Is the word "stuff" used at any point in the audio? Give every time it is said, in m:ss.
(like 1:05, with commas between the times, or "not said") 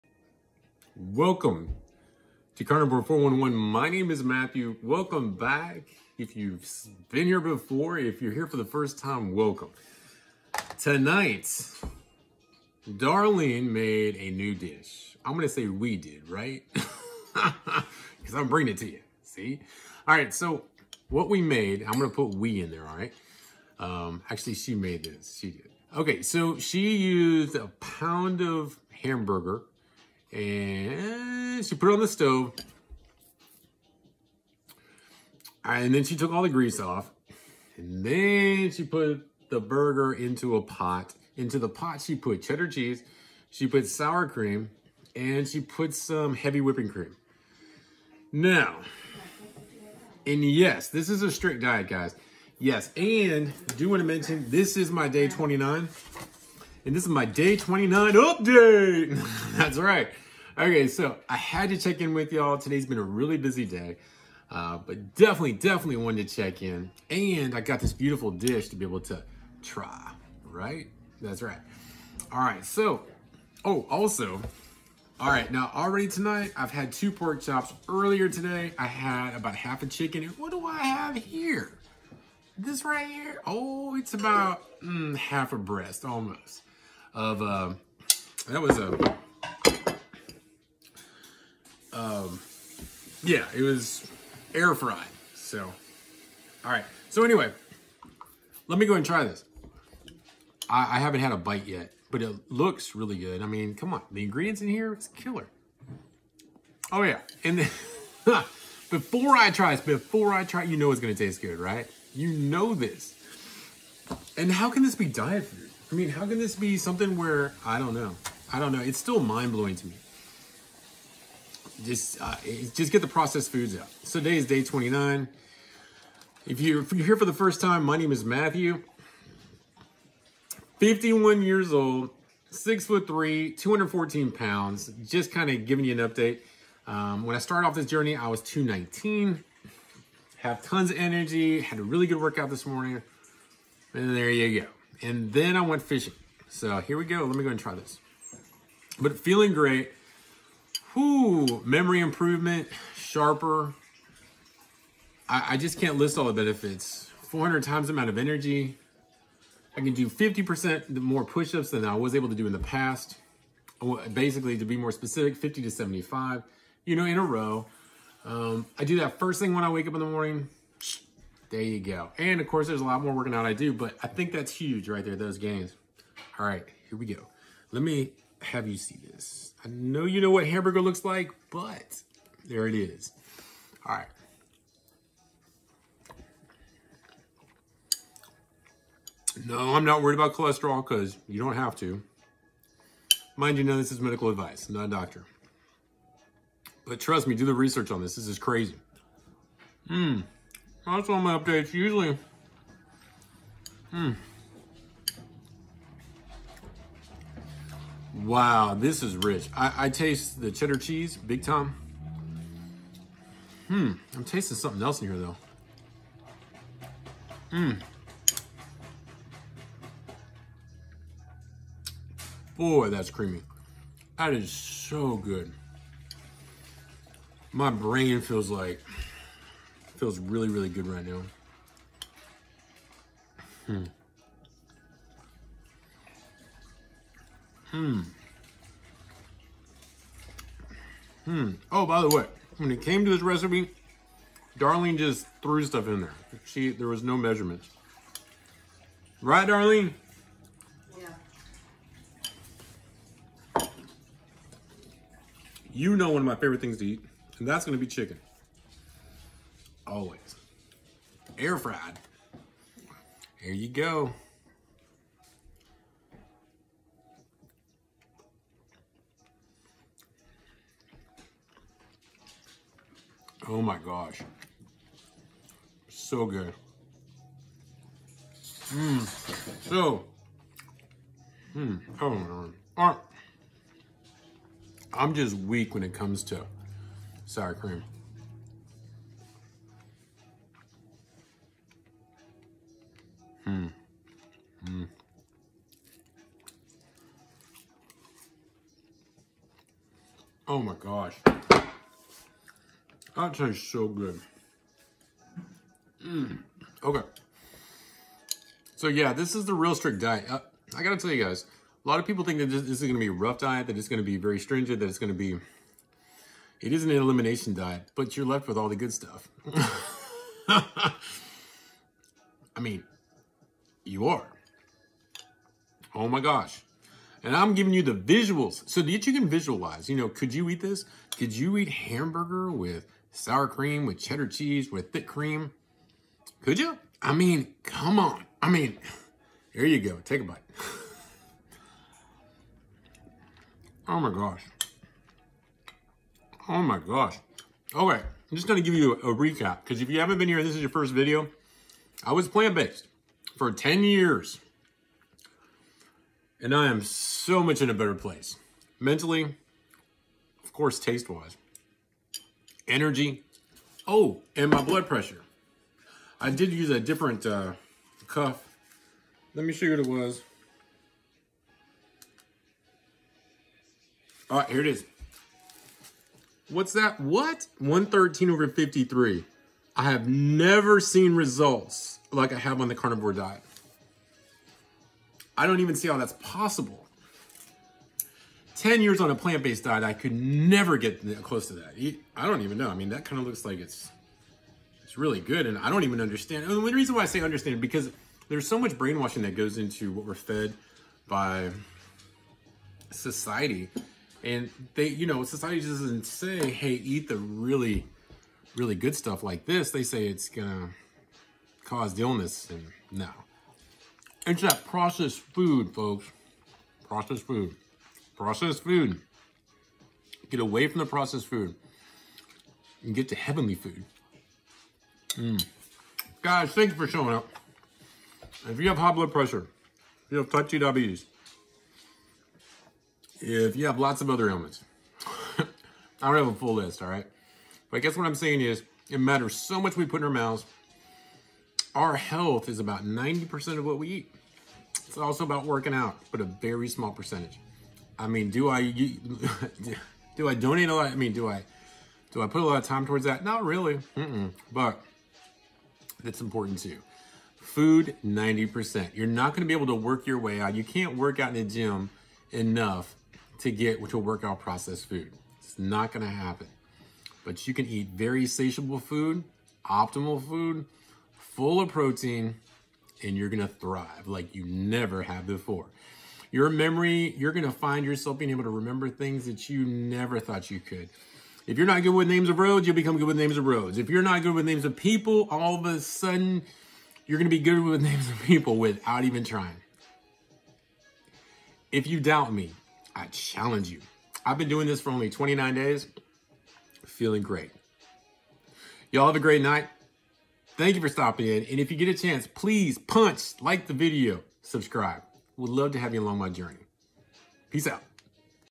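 4:05, 5:18, 6:48.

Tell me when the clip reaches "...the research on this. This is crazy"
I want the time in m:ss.
3:17.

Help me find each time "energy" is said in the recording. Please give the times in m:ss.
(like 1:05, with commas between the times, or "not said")
2:20, 2:38, 6:02.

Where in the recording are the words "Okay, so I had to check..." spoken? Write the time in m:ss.
1:00.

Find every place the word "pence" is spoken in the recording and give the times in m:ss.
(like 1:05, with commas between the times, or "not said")
not said.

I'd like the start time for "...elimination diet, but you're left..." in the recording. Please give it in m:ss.
5:16.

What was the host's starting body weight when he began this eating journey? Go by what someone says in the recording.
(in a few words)
219.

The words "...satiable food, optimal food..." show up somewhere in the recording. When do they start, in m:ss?
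7:48.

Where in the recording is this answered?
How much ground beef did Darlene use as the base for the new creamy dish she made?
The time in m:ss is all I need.
0:27.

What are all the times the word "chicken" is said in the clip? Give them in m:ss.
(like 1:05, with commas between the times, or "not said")
1:19, 4:17.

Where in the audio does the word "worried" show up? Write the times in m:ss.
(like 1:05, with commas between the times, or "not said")
3:10.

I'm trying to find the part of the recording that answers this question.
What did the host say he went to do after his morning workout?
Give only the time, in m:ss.
2:25.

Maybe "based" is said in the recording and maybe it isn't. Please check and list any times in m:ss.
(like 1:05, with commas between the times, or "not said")
5:52, 6:29.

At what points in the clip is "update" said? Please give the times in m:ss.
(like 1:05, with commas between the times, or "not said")
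0:58, 2:16, 3:21.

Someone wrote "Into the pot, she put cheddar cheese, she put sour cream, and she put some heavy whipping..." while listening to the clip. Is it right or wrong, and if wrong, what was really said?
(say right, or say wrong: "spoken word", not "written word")
right.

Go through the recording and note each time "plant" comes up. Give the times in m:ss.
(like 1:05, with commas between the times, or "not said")
5:52, 6:29.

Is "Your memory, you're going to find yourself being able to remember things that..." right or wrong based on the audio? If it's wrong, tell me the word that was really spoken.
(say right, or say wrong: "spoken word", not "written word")
right.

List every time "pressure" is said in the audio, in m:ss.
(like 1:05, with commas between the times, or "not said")
6:04, 7:09.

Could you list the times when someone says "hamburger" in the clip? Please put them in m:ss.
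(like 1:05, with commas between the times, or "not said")
0:28, 3:00, 5:31.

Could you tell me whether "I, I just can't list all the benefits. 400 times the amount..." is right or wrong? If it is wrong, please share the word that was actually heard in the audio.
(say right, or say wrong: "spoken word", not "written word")
right.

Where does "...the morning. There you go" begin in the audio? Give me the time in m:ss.
2:50.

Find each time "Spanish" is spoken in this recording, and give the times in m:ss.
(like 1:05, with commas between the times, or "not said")
not said.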